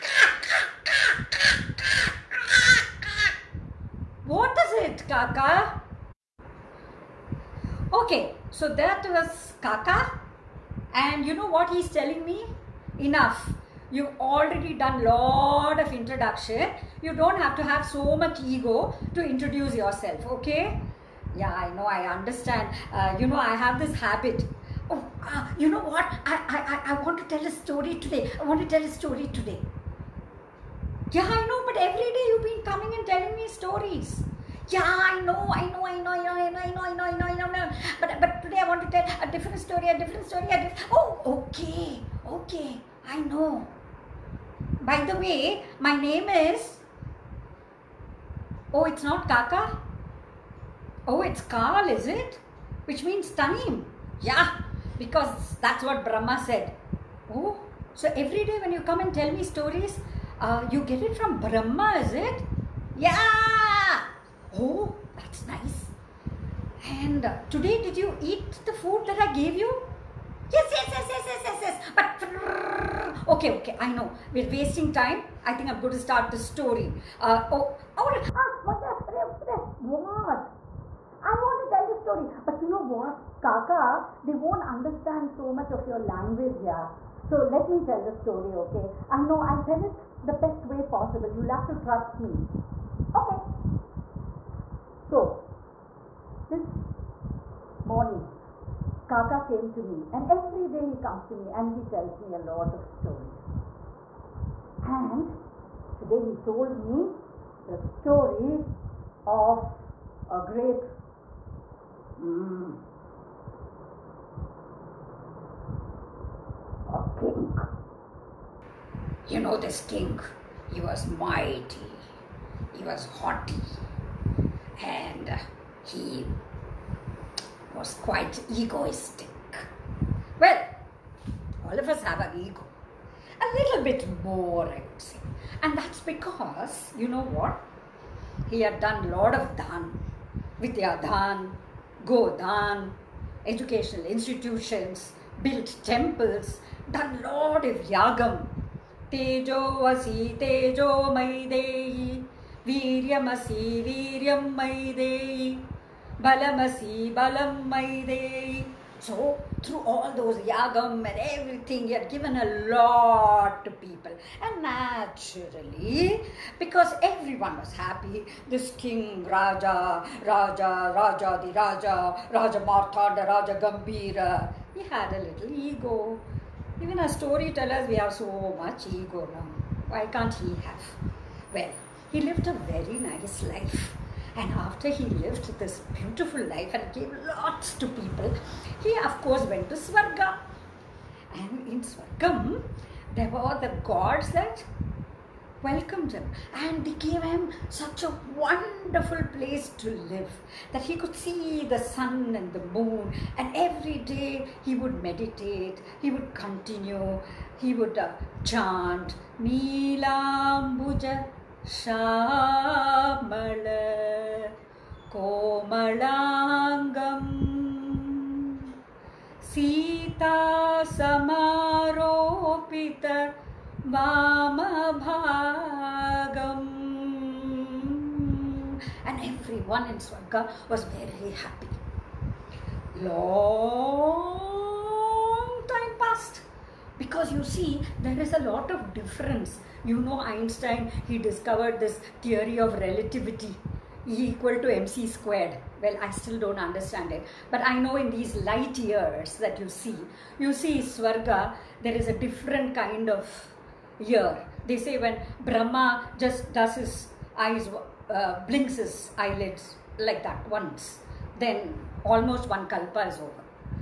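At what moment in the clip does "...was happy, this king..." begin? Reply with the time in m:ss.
2:47.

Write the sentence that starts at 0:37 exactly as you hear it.
But, but today I want to tell a different story, a different story.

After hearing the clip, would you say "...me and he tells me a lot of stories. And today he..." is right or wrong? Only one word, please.
right.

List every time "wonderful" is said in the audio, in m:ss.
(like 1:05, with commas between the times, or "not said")
3:18.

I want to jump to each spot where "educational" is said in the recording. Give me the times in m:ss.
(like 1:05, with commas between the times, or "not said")
2:23.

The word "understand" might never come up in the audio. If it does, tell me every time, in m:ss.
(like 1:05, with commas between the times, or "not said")
0:22, 1:24, 4:06.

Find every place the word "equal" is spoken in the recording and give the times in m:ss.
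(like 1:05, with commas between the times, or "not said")
4:04.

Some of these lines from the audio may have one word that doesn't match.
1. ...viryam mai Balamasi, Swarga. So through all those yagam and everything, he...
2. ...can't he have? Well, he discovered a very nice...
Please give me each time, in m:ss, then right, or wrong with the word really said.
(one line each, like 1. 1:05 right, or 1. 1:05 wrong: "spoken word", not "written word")
1. 2:33 wrong: "Balamaidei", not "Swarga"
2. 3:00 wrong: "lived", not "discovered".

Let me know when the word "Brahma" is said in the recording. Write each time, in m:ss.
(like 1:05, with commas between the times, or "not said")
0:56, 1:01, 4:15.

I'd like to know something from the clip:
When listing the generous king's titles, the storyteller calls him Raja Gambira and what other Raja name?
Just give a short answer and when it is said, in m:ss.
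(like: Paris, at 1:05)
Raja Marthanda, at 2:52.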